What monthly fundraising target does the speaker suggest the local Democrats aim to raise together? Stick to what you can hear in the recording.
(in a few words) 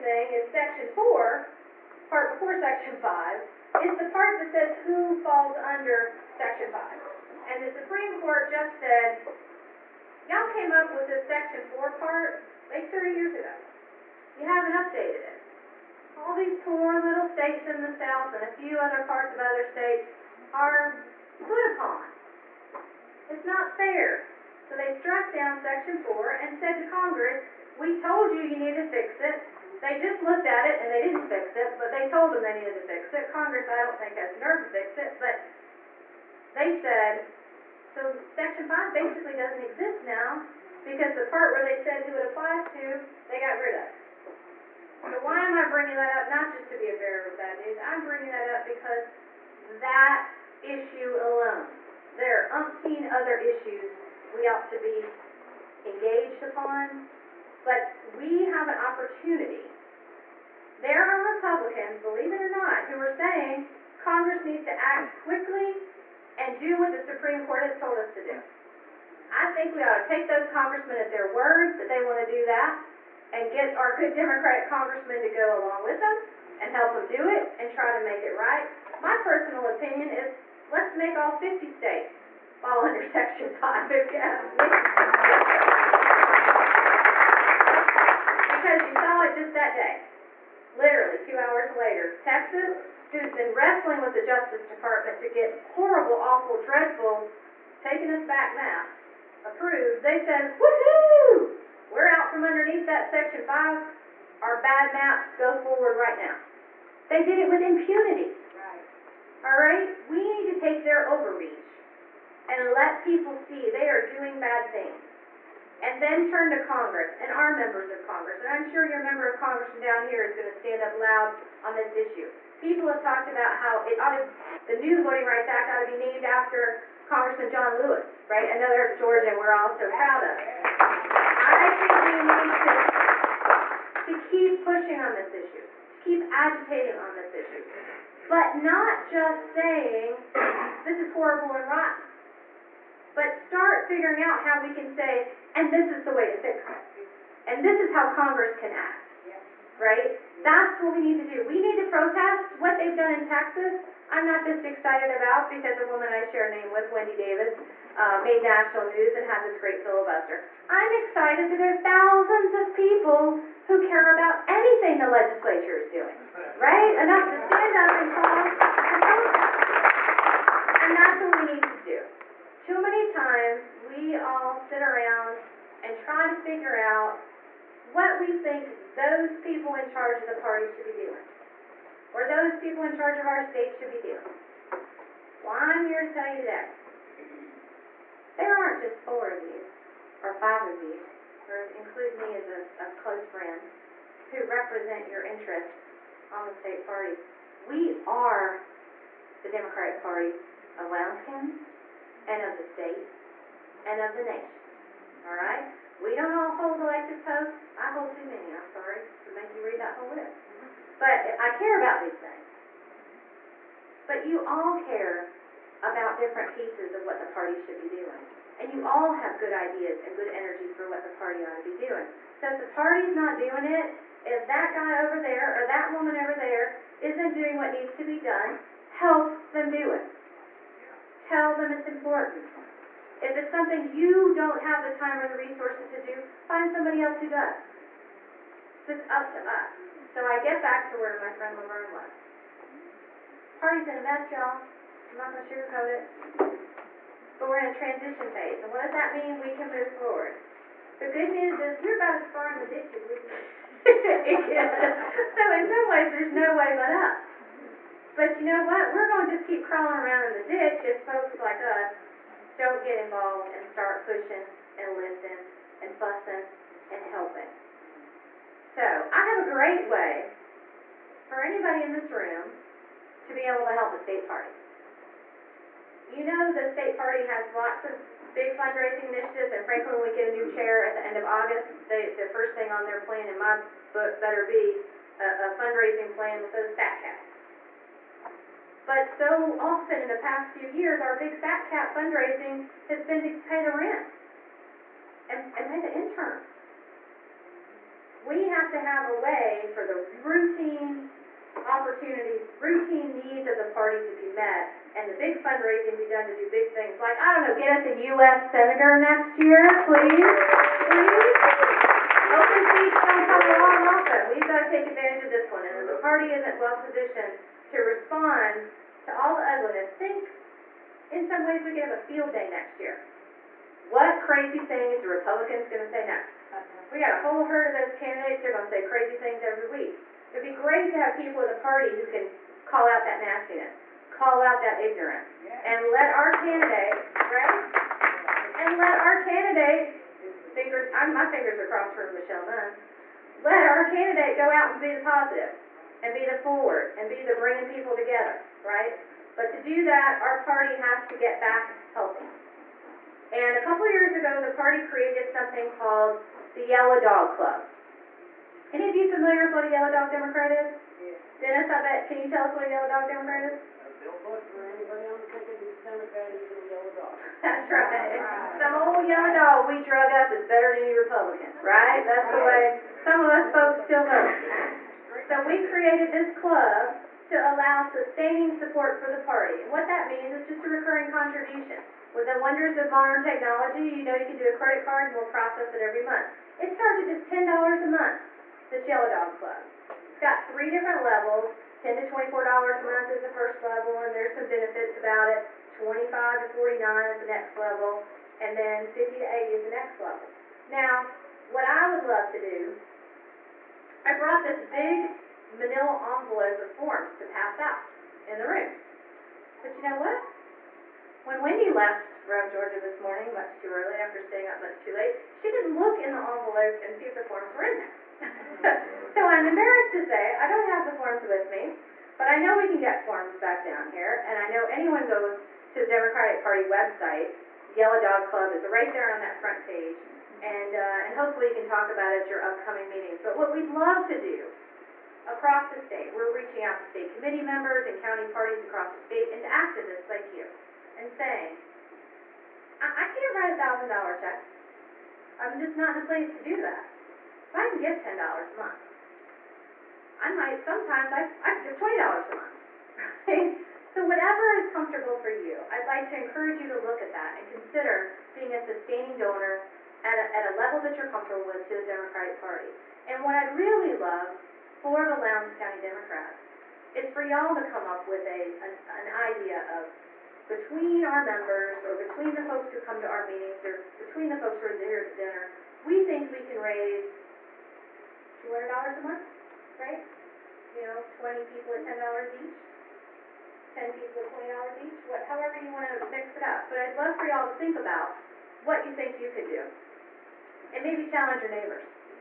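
$200.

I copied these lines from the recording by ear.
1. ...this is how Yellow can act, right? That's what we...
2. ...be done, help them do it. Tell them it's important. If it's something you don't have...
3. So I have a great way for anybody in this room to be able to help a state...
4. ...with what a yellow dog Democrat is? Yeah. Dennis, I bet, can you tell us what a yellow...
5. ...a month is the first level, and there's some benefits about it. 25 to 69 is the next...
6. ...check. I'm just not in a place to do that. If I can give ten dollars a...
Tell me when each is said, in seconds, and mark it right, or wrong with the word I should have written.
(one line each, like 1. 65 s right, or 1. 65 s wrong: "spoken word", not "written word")
1. 147 s wrong: "Congress", not "Yellow"
2. 228 s right
3. 268 s right
4. 359 s right
5. 392 s wrong: "49", not "69"
6. 444 s right.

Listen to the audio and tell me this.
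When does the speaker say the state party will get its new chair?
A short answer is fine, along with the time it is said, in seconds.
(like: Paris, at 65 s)
end of August, at 281 s.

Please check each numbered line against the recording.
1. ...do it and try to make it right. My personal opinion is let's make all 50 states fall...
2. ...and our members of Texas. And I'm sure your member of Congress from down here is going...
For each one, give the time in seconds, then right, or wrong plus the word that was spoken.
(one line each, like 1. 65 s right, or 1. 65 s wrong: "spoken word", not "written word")
1. 77 s right
2. 117 s wrong: "Congress", not "Texas".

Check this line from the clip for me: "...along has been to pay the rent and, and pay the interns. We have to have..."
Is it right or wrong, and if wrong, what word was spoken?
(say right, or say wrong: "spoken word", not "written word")
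wrong: "fundraising", not "along".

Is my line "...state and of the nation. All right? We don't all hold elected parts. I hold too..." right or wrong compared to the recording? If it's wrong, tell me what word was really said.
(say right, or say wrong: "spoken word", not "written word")
wrong: "posts", not "parts".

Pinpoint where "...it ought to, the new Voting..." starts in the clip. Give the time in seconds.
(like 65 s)
123 s.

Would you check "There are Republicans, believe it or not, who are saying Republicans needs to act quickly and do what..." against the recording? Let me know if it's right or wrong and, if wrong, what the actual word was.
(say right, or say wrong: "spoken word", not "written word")
wrong: "Congress", not "Republicans".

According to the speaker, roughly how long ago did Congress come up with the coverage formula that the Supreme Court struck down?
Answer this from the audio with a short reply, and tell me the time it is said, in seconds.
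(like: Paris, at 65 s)
30 years, at 12 s.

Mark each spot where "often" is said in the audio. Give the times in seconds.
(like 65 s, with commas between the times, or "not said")
289 s, 313 s.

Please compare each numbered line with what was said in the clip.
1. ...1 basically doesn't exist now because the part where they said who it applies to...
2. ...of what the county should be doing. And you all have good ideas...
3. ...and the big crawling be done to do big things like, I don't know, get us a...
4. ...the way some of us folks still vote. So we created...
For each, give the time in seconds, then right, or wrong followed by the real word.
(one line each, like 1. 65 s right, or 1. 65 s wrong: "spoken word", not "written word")
1. 38 s wrong: "5", not "1"
2. 216 s wrong: "party", not "county"
3. 304 s wrong: "fundraising", not "crawling"
4. 372 s right.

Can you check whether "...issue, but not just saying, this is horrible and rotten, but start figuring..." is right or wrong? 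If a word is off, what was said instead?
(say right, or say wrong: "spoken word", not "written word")
right.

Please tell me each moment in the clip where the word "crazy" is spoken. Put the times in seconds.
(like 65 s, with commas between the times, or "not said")
324 s, 328 s.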